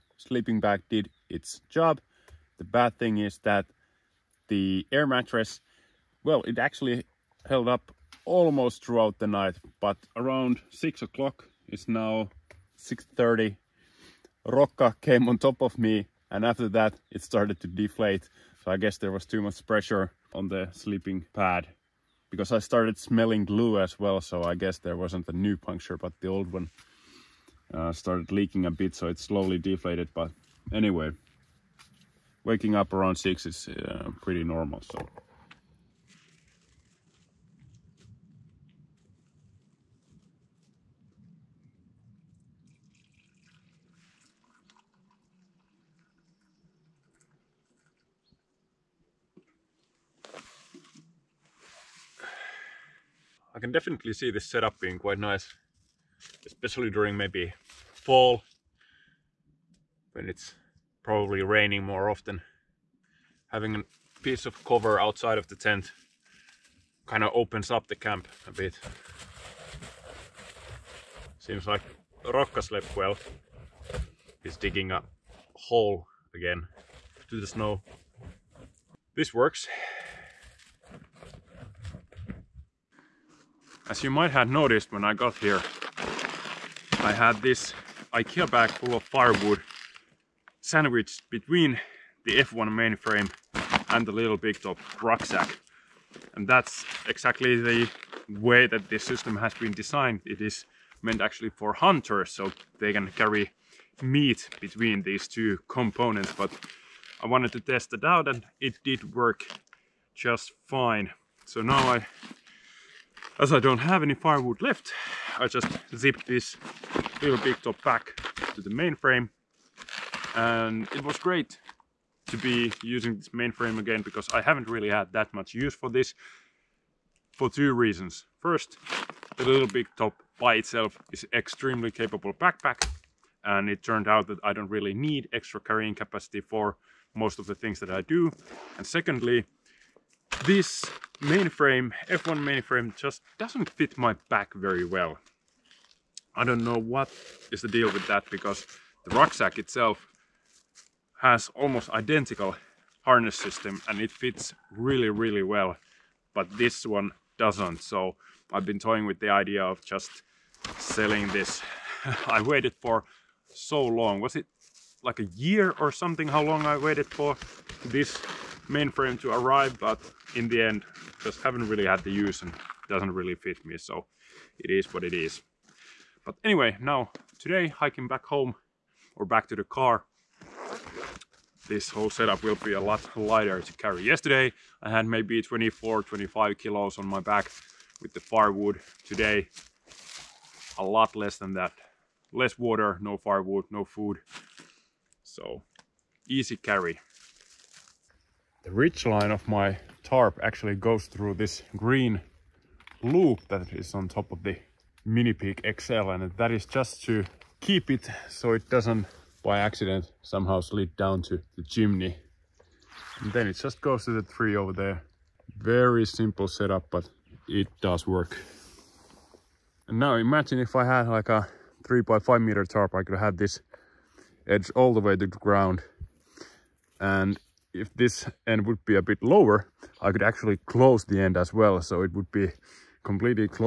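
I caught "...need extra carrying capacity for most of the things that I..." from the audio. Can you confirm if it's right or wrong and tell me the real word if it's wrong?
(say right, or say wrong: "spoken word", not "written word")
right.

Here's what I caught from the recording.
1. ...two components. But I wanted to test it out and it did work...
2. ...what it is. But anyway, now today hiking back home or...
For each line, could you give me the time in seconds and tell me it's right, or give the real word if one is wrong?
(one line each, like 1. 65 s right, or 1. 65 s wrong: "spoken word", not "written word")
1. 105 s right
2. 174 s right.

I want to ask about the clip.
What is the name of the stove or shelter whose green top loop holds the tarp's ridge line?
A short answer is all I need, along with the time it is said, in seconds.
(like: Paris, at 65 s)
Minipeak XL, at 205 s.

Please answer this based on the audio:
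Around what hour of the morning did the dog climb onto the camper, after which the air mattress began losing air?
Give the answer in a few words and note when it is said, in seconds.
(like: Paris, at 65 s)
6, at 10 s.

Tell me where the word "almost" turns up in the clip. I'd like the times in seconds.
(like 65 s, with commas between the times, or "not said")
8 s, 151 s.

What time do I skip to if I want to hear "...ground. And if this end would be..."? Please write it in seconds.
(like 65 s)
225 s.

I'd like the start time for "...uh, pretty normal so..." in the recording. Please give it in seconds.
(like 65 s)
33 s.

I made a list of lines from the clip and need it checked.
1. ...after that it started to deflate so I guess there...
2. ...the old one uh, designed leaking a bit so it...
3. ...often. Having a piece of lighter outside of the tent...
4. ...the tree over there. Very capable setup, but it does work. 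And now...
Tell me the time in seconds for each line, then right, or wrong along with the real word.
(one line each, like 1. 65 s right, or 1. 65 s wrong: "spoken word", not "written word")
1. 16 s right
2. 26 s wrong: "started", not "designed"
3. 62 s wrong: "cover", not "lighter"
4. 214 s wrong: "simple", not "capable".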